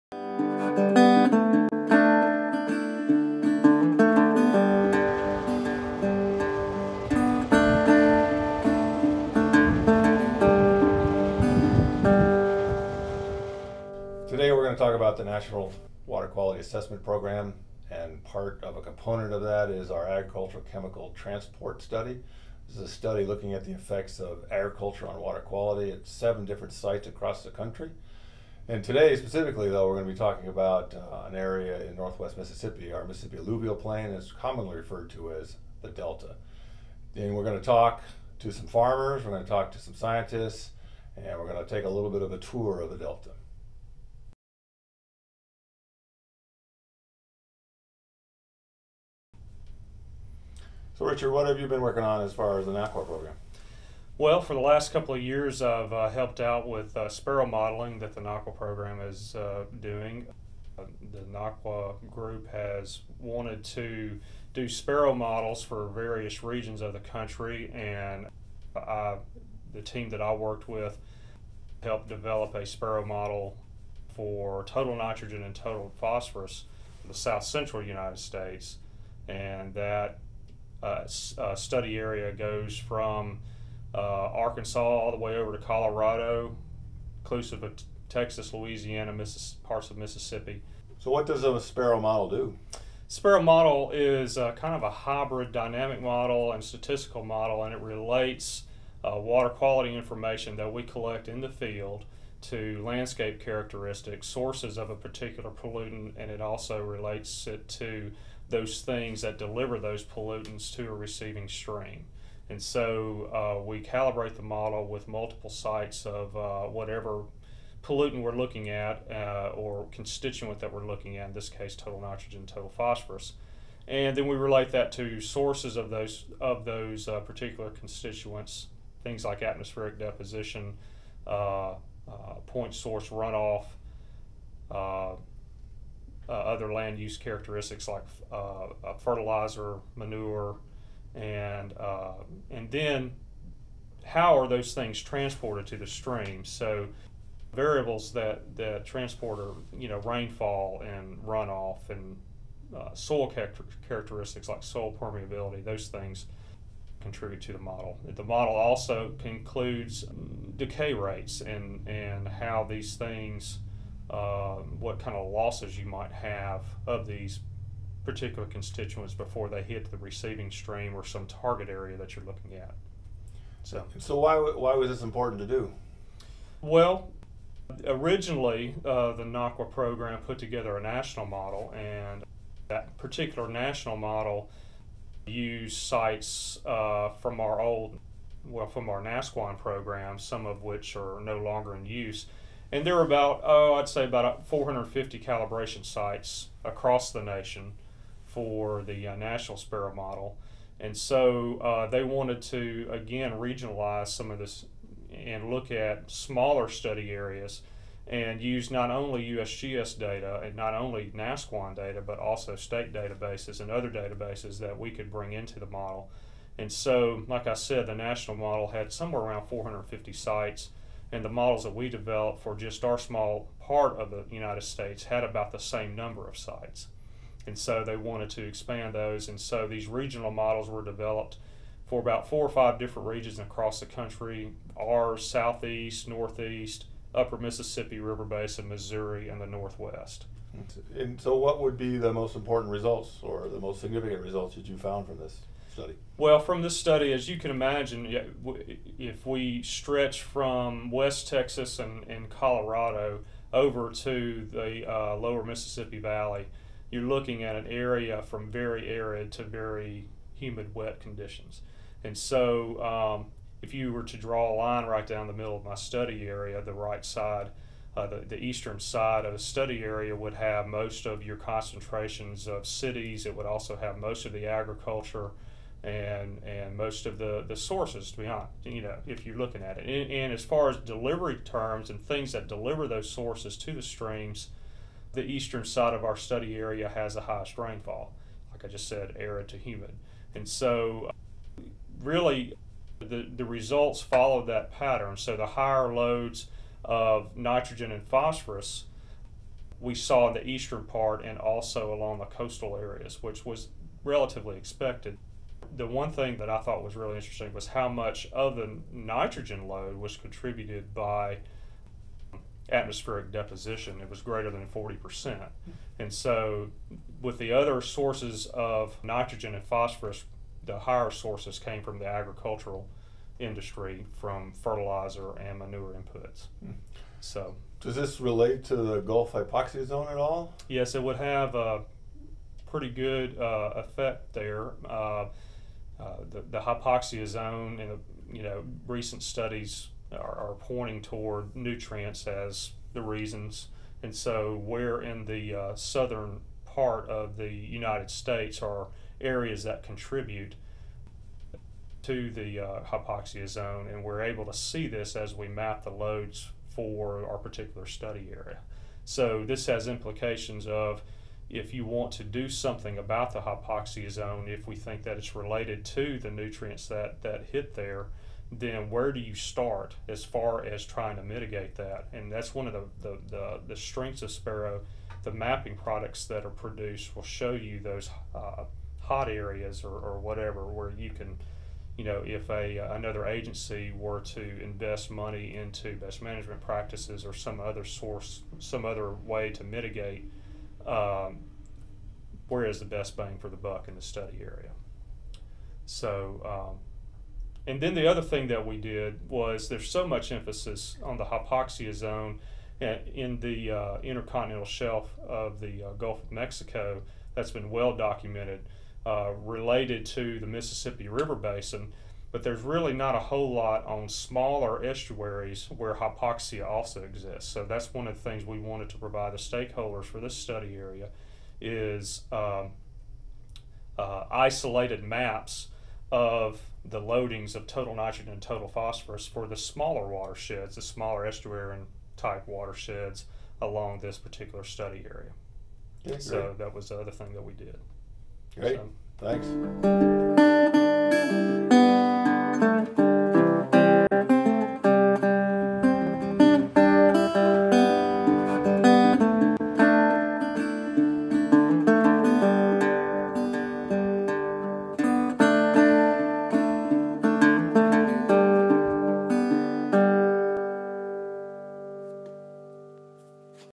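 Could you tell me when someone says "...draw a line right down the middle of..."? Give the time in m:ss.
4:24.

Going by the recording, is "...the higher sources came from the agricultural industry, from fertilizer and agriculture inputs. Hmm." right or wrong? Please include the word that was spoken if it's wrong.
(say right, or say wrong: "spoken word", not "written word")
wrong: "manure", not "agriculture".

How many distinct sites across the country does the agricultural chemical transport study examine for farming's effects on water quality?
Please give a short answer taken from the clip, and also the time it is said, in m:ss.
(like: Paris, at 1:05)
7, at 0:26.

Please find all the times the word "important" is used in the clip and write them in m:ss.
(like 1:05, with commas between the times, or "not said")
2:55, 4:02.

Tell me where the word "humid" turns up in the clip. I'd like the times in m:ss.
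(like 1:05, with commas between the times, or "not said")
4:20, 4:49.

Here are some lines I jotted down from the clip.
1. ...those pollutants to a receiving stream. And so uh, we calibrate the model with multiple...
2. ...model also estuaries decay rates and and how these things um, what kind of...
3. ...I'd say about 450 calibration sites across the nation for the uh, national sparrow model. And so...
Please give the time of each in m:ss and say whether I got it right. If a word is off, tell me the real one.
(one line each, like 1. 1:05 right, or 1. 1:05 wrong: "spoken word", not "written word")
1. 1:49 right
2. 2:38 wrong: "includes", not "estuaries"
3. 3:13 right.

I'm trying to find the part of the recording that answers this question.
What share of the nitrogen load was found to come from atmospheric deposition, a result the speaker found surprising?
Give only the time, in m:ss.
5:14.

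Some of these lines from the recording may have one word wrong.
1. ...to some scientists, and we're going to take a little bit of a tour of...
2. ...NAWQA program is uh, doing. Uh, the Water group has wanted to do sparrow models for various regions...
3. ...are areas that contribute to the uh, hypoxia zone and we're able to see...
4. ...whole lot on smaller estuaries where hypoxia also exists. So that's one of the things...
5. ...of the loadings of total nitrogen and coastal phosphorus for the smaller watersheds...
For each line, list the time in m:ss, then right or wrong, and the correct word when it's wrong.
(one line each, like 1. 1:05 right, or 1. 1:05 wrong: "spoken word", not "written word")
1. 0:39 right
2. 0:58 wrong: "NAWQA", not "Water"
3. 5:48 right
4. 6:53 right
5. 7:06 wrong: "total", not "coastal".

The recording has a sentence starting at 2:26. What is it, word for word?
So variables that that transport are you know rainfall and runoff and uh, soil character- characteristics like soil permeability.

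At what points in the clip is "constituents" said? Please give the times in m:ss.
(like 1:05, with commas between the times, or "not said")
1:59, 2:07, 2:48.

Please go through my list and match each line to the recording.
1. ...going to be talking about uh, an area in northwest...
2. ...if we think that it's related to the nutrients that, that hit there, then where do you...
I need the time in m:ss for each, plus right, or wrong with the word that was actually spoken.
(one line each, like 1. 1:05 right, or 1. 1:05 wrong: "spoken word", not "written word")
1. 0:30 right
2. 6:04 right.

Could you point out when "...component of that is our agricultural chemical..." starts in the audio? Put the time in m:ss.
0:18.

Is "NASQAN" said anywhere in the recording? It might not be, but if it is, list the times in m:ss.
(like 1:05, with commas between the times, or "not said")
3:09, 3:31.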